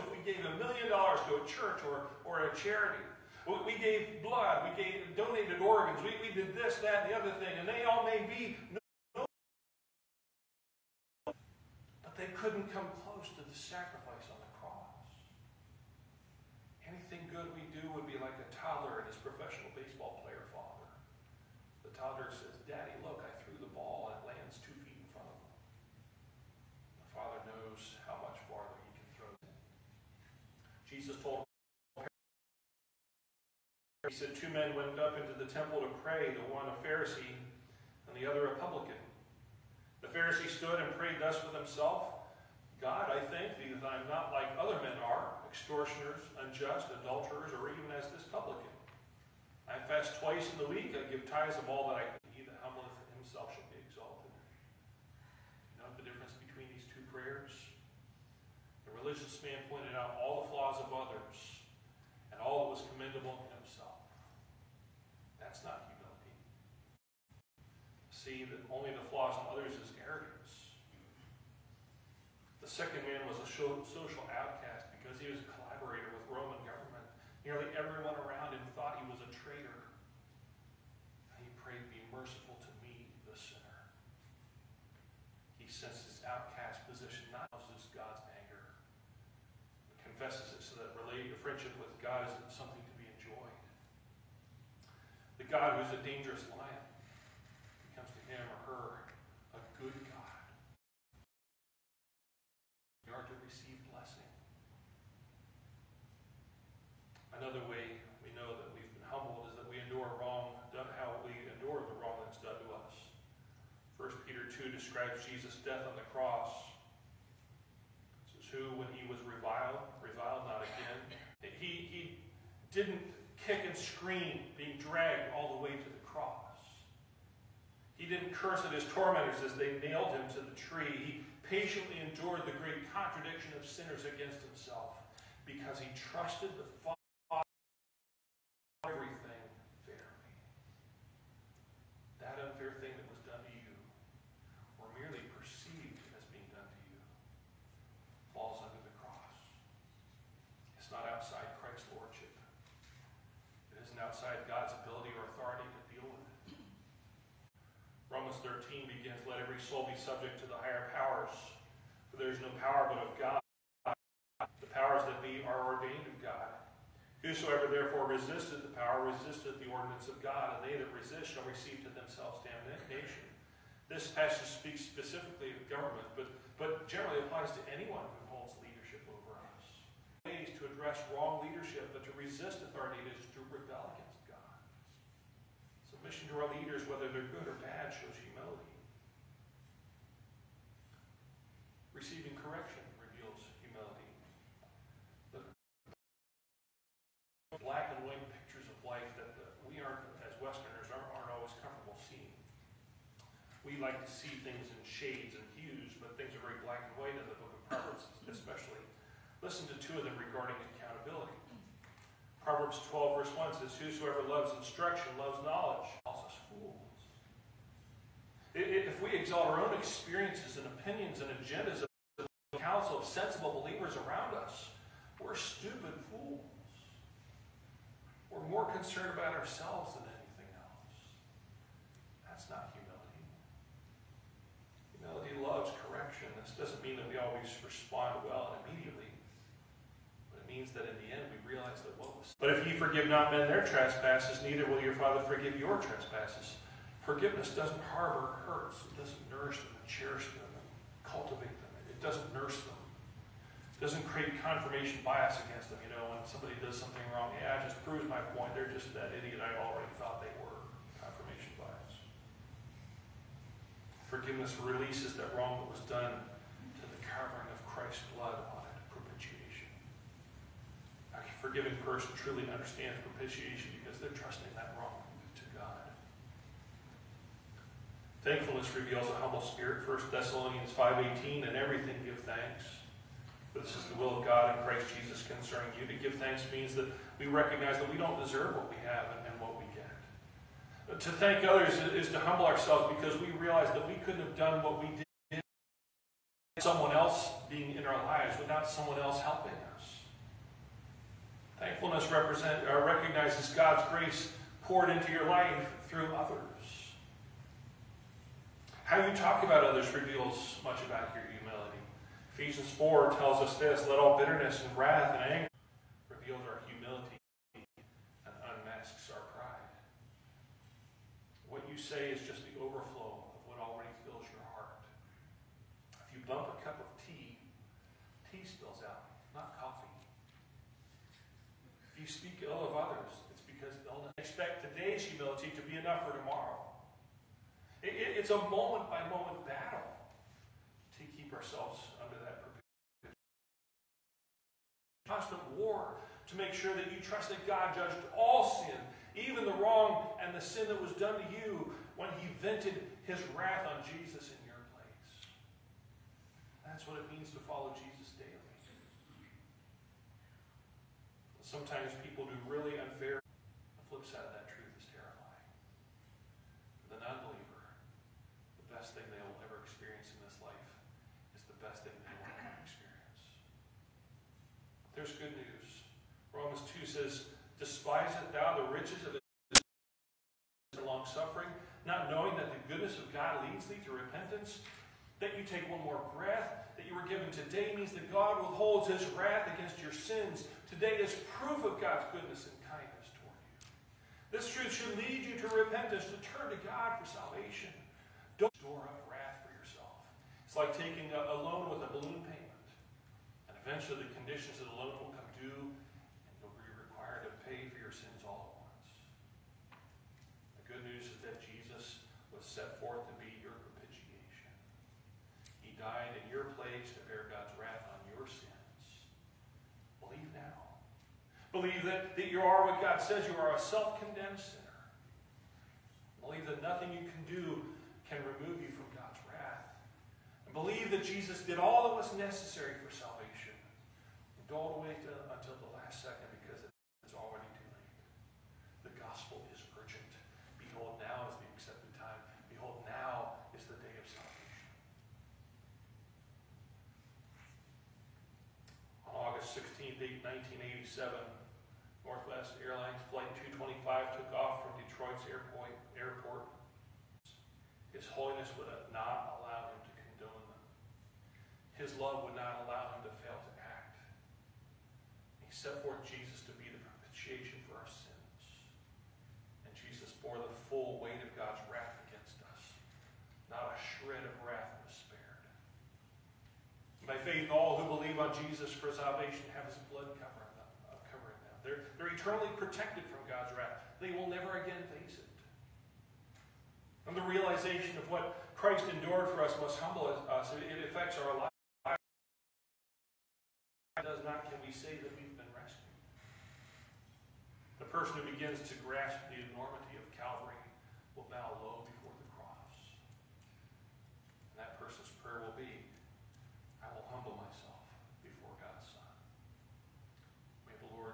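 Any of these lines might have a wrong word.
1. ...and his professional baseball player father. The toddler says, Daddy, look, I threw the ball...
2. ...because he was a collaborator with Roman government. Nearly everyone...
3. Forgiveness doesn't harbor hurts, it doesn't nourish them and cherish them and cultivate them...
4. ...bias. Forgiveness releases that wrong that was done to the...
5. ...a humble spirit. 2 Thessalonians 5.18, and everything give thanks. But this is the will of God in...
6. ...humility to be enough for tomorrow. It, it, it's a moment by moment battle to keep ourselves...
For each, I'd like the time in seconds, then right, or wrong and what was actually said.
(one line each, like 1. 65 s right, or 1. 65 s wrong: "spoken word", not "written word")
1. 18 s right
2. 75 s right
3. 247 s right
4. 261 s right
5. 279 s wrong: "1", not "2"
6. 335 s right.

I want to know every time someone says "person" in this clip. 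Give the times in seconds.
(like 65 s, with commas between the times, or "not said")
271 s, 497 s, 504 s.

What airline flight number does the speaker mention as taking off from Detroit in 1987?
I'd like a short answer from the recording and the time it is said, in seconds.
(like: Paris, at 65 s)
225, at 453 s.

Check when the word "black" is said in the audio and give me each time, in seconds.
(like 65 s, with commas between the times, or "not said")
197 s, 206 s.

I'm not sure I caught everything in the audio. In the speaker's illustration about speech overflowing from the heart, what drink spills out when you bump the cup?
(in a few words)
tea.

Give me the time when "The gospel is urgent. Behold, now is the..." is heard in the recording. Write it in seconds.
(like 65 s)
438 s.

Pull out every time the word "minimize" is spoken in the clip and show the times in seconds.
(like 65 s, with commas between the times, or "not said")
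not said.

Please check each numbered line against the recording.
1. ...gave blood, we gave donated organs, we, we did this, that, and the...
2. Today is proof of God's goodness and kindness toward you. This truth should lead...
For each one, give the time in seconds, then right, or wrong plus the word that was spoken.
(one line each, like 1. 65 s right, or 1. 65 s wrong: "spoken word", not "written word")
1. 3 s right
2. 390 s right.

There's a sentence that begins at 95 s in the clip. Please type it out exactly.
The God who's a dangerous lion becomes to him or her a good God.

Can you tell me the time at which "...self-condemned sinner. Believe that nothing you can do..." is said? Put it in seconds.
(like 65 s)
423 s.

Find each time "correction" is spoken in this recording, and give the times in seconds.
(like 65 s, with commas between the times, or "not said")
192 s, 235 s.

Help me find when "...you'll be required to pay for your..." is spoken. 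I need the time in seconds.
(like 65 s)
406 s.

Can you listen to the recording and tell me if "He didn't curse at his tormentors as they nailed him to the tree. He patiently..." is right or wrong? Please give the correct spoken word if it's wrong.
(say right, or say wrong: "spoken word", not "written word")
right.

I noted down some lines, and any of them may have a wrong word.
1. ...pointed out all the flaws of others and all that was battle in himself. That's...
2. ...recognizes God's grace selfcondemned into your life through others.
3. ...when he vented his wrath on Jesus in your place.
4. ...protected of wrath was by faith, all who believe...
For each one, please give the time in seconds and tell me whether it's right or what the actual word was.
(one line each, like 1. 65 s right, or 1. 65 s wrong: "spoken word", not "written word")
1. 59 s wrong: "commendable", not "battle"
2. 302 s wrong: "poured", not "selfcondemned"
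3. 351 s right
4. 473 s wrong: "shred", not "protected".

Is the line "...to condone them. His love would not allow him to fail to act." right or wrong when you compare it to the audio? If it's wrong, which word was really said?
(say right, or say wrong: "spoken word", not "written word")
right.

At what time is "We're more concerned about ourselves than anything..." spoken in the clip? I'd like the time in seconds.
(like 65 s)
228 s.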